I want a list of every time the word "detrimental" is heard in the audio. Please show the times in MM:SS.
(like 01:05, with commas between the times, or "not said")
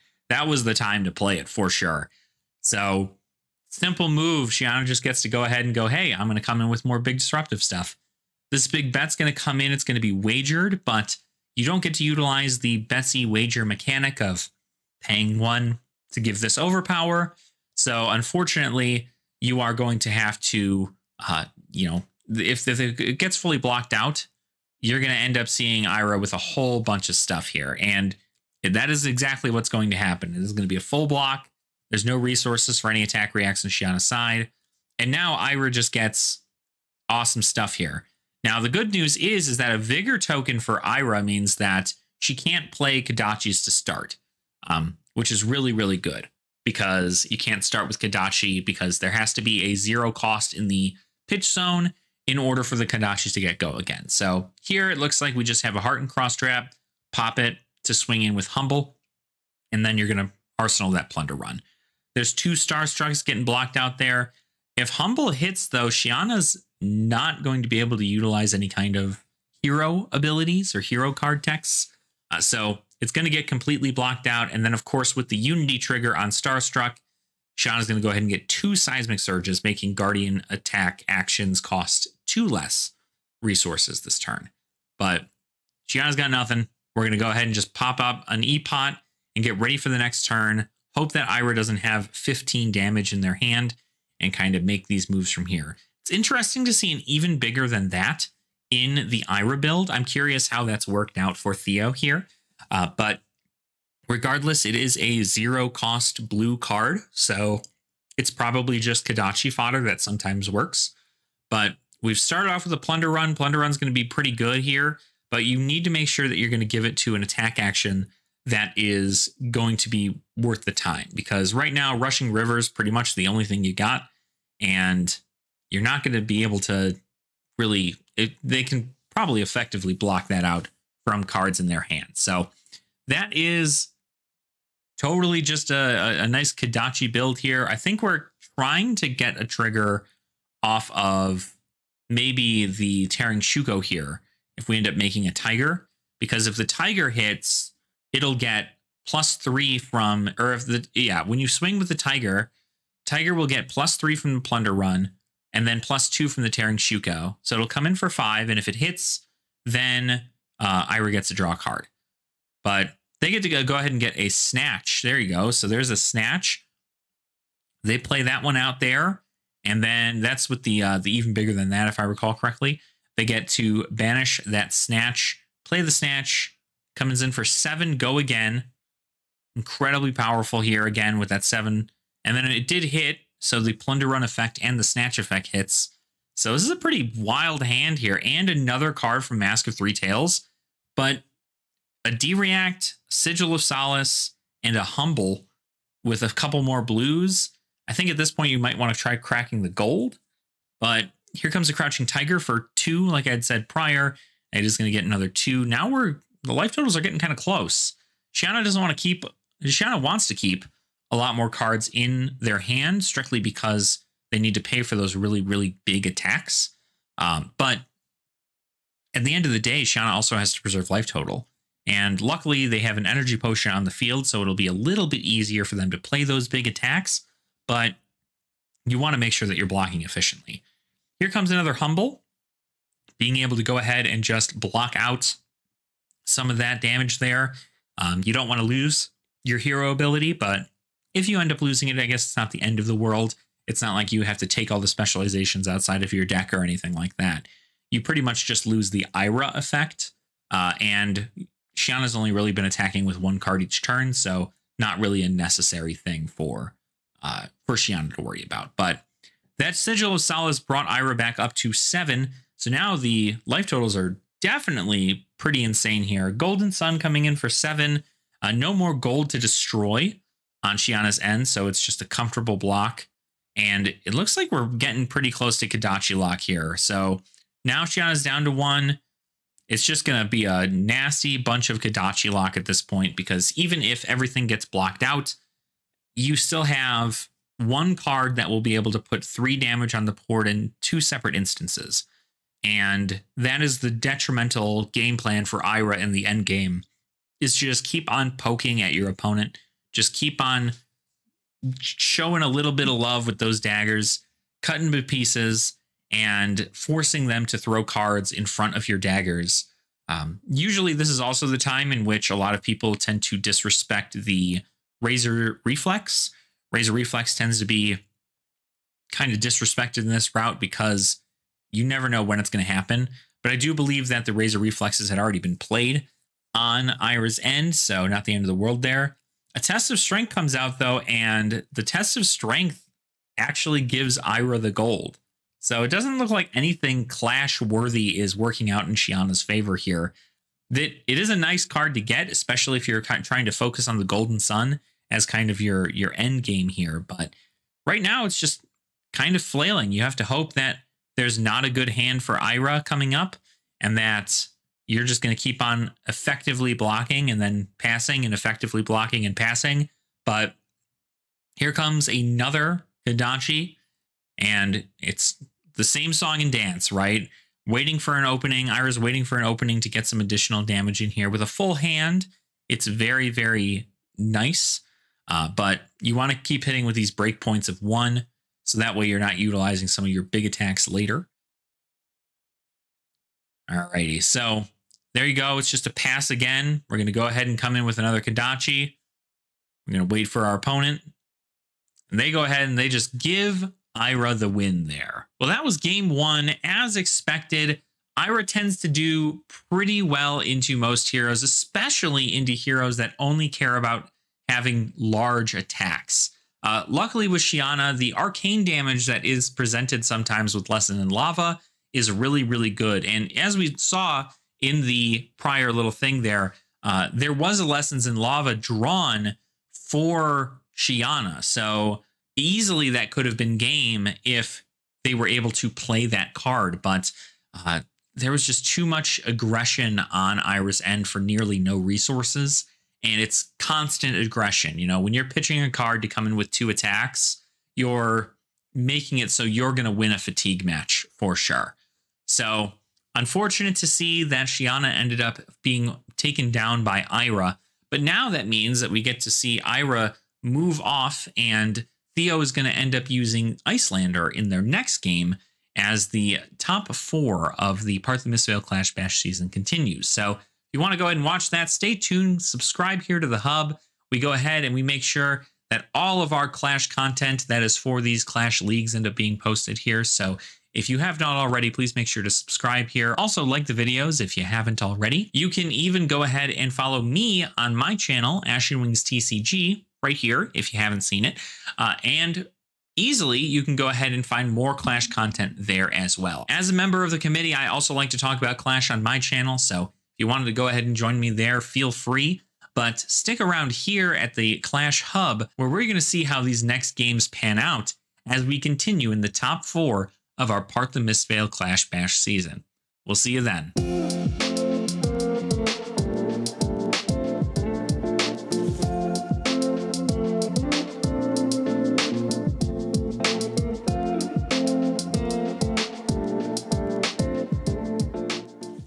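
04:53.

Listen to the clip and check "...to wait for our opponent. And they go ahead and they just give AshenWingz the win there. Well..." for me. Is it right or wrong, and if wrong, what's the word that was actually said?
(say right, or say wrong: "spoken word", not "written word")
wrong: "Ira", not "AshenWingz".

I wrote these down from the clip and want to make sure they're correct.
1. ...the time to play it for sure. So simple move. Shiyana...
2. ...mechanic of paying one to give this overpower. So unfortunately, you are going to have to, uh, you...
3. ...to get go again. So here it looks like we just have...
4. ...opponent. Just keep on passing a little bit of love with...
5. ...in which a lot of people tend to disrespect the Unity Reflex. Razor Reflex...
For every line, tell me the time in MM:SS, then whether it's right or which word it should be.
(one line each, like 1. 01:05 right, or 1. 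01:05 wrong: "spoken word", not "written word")
1. 00:00 right
2. 00:13 right
3. 00:53 right
4. 04:59 wrong: "showing", not "passing"
5. 05:11 wrong: "Razor", not "Unity".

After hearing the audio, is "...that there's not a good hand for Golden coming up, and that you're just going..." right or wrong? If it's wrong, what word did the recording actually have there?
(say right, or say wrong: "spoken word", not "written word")
wrong: "Ira", not "Golden".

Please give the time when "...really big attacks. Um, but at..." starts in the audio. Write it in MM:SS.
03:35.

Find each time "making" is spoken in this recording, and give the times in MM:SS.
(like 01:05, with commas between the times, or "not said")
01:19, 02:24, 07:18.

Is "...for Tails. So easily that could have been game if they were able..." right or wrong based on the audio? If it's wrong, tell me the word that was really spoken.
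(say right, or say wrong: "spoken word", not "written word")
wrong: "Shiyana", not "Tails".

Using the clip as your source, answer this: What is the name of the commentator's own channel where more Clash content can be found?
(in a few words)
AshenWingz TCG.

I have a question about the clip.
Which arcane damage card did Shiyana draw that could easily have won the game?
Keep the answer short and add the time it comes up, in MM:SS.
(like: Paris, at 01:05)
Lesson in Lava, at 06:50.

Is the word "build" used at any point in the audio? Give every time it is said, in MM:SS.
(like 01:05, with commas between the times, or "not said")
01:39, 02:17.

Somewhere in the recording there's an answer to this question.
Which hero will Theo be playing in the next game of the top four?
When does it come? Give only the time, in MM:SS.
07:33.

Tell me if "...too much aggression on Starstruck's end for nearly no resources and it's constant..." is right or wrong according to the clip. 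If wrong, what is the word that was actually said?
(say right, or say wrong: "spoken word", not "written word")
wrong: "Ira", not "Starstruck".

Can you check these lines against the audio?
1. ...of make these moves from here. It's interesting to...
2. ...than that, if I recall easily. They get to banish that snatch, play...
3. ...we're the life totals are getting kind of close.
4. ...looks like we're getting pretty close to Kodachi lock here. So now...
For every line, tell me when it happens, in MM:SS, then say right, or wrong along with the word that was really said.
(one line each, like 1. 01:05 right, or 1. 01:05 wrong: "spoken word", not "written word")
1. 01:34 right
2. 02:51 wrong: "correctly", not "easily"
3. 03:25 right
4. 04:34 right.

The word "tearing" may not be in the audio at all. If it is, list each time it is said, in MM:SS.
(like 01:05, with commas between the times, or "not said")
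02:23, 02:36.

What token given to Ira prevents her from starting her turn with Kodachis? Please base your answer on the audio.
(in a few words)
Vigor token.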